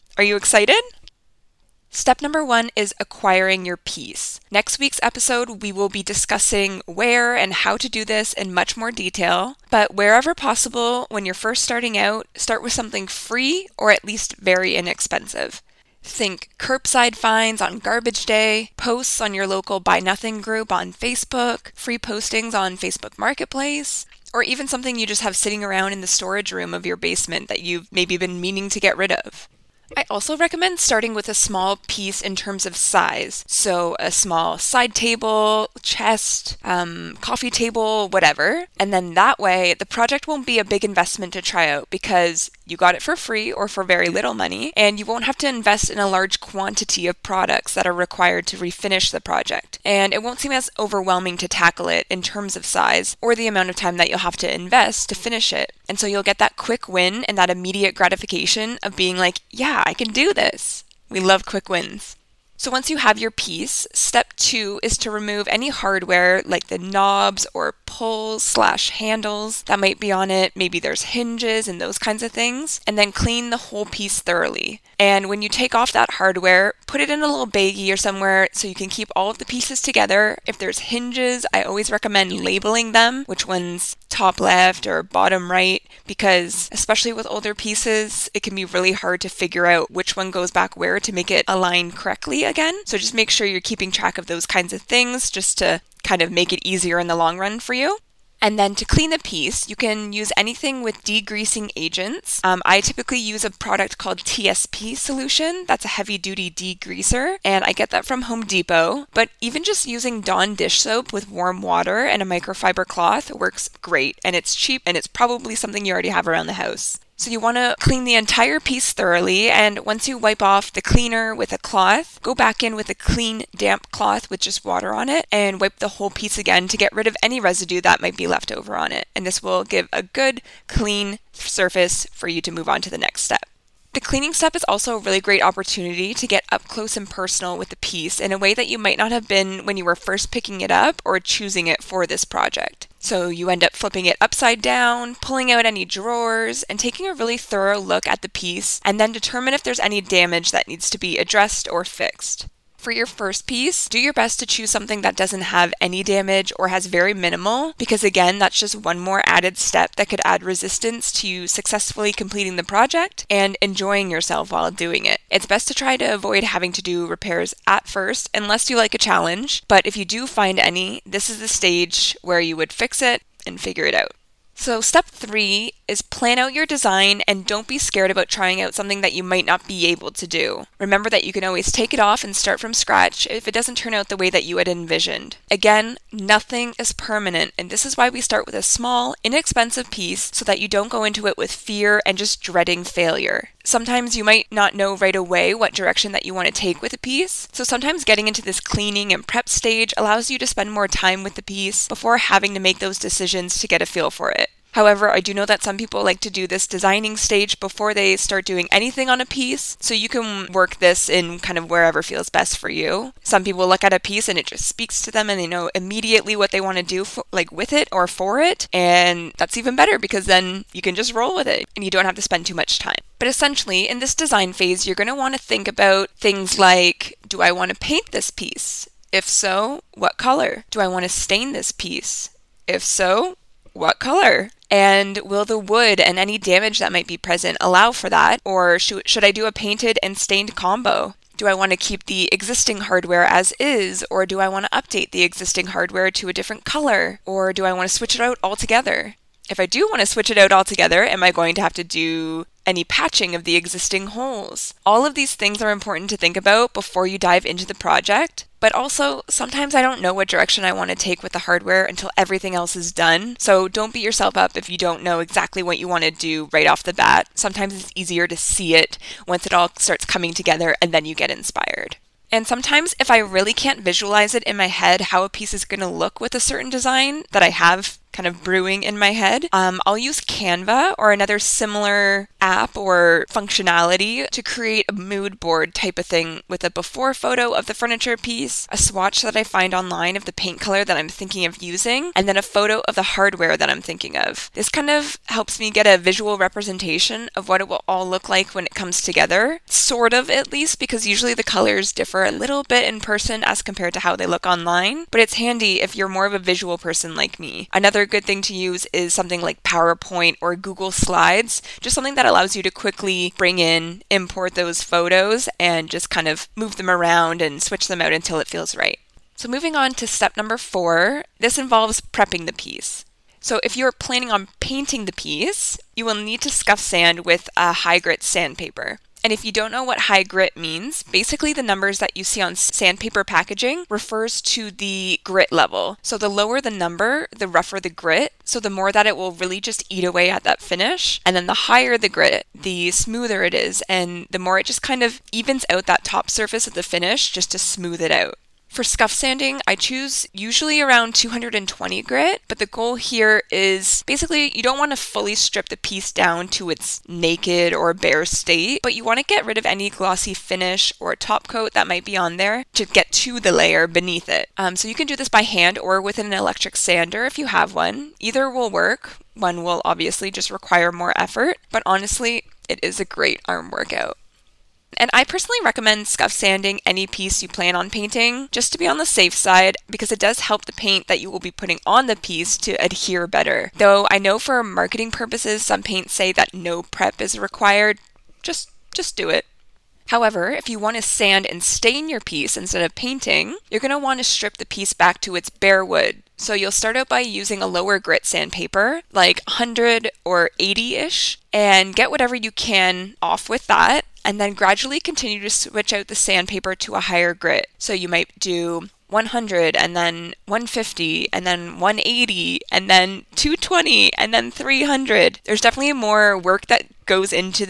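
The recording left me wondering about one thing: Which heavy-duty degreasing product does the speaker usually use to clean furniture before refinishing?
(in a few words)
TSP Solution.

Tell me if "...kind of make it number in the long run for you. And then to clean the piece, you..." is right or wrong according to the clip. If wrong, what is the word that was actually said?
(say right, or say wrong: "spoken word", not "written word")
wrong: "easier", not "number".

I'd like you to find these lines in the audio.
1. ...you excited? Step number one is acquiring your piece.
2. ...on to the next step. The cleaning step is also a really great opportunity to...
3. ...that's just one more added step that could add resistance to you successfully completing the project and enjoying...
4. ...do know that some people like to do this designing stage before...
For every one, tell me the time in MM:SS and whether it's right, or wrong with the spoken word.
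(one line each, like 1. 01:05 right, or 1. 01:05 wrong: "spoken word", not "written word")
1. 00:00 right
2. 02:12 right
3. 02:38 right
4. 03:25 right.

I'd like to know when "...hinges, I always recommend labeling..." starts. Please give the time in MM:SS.
01:20.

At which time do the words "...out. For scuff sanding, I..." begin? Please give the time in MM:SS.
05:48.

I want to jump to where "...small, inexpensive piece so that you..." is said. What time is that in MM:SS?
03:08.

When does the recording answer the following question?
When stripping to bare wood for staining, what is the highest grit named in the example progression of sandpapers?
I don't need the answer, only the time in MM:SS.
06:54.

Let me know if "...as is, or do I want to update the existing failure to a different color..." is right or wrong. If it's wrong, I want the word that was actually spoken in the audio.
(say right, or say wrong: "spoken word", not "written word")
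wrong: "hardware", not "failure".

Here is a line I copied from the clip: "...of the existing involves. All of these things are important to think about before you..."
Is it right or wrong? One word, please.
wrong.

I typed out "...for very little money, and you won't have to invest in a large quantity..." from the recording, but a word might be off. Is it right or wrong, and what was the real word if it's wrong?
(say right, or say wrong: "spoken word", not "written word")
right.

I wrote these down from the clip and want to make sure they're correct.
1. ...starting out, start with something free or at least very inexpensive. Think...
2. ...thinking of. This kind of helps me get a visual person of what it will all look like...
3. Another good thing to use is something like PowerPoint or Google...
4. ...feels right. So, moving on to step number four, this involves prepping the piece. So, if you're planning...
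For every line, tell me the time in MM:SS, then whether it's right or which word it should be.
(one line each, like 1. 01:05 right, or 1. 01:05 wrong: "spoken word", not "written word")
1. 00:11 right
2. 04:53 wrong: "representation", not "person"
3. 05:07 right
4. 05:18 right.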